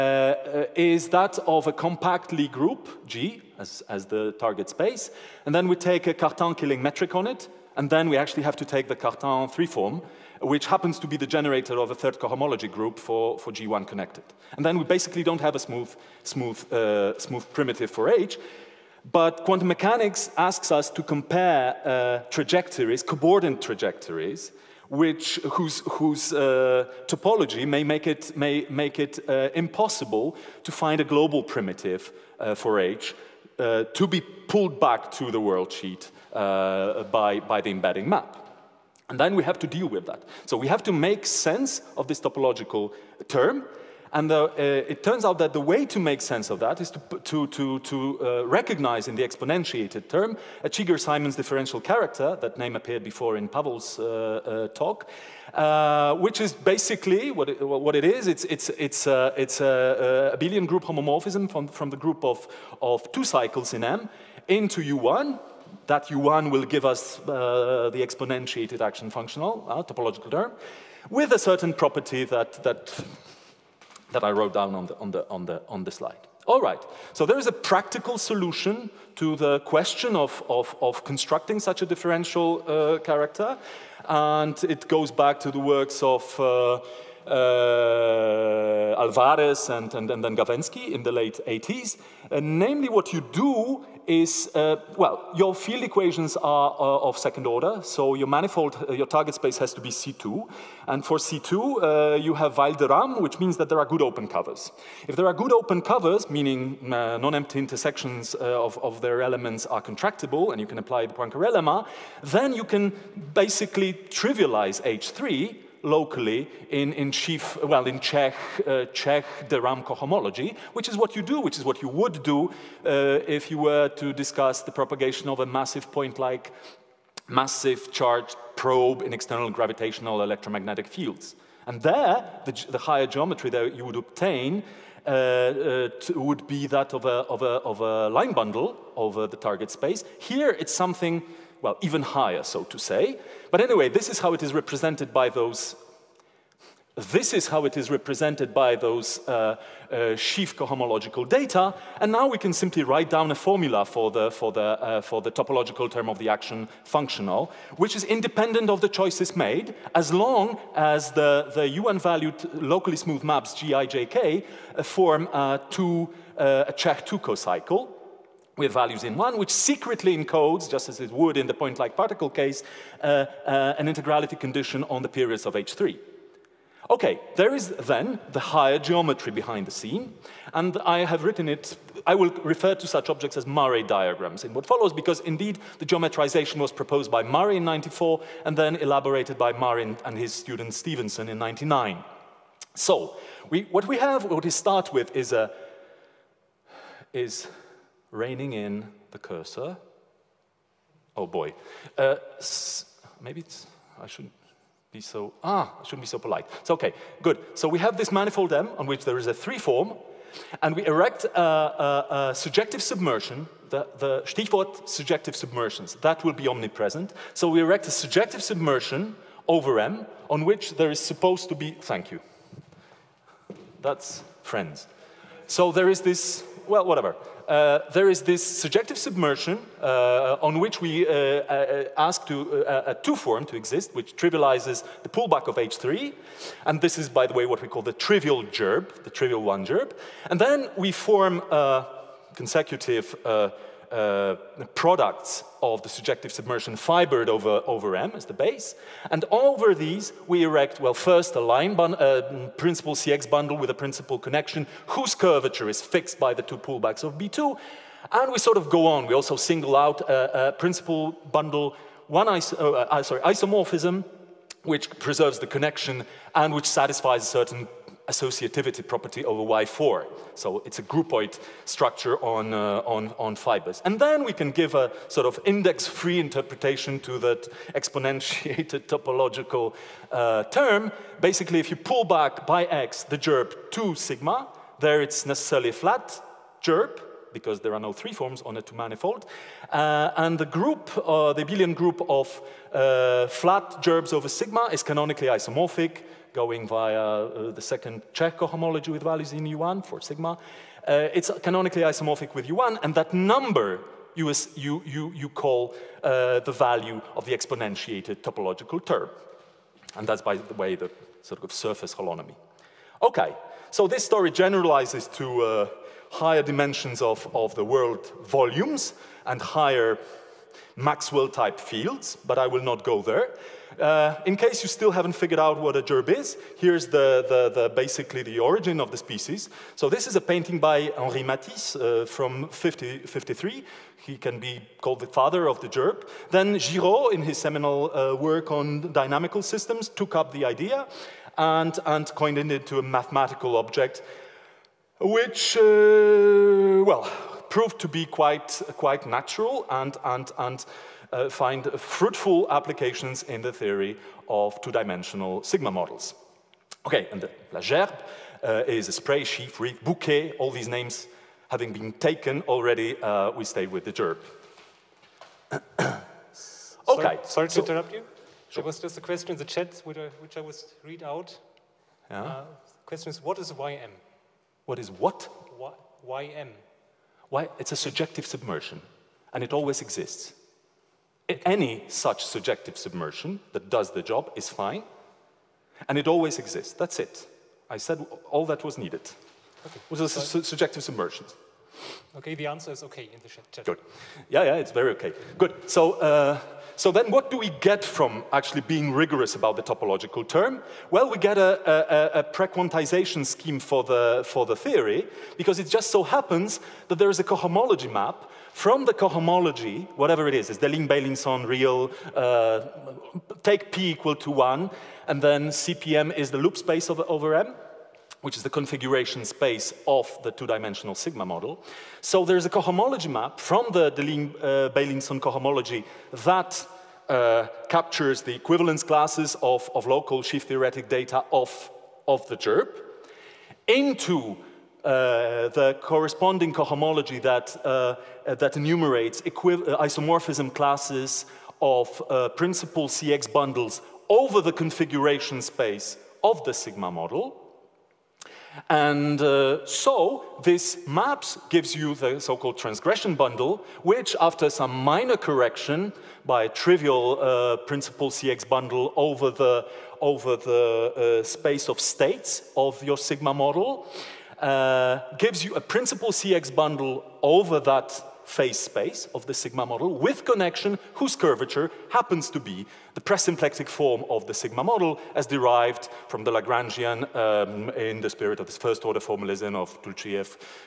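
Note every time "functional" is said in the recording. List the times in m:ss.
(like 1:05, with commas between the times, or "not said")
1:09, 2:36.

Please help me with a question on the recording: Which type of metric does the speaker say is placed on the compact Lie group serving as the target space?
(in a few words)
Cartan-Killing metric.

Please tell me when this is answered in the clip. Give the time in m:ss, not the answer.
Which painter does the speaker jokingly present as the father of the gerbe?
5:30.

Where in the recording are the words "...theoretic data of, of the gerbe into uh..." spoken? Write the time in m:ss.
7:10.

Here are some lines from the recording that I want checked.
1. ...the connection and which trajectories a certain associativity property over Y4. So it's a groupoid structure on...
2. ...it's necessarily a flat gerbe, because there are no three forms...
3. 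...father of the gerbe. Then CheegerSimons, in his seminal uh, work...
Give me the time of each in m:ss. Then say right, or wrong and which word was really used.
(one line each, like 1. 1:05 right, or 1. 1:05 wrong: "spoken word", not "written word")
1. 4:25 wrong: "satisfies", not "trajectories"
2. 4:45 right
3. 5:35 wrong: "Giraud", not "CheegerSimons".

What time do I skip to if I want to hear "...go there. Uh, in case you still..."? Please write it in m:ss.
5:22.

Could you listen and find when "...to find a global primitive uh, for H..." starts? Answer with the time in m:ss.
0:30.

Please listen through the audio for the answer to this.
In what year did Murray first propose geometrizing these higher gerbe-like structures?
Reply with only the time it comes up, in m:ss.
3:07.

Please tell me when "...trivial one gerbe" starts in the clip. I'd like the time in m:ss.
3:59.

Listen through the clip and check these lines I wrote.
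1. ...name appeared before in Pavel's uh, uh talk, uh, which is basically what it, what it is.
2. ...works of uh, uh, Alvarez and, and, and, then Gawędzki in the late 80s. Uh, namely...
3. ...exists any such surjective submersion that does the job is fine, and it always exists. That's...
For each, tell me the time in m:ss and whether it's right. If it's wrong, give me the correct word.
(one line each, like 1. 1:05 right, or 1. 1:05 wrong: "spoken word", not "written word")
1. 0:52 right
2. 1:25 right
3. 6:19 right.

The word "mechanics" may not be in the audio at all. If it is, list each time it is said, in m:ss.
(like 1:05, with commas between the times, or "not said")
0:19.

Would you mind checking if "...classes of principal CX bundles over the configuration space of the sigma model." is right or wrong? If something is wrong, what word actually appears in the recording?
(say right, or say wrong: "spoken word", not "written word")
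right.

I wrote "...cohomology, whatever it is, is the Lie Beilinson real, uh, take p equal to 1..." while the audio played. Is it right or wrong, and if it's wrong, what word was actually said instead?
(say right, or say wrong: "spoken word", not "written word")
wrong: "Ling", not "Lie".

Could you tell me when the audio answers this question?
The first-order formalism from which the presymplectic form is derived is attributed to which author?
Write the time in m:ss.
7:59.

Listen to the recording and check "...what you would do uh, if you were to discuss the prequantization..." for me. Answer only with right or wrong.
wrong.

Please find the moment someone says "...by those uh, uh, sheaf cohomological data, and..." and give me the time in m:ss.
2:28.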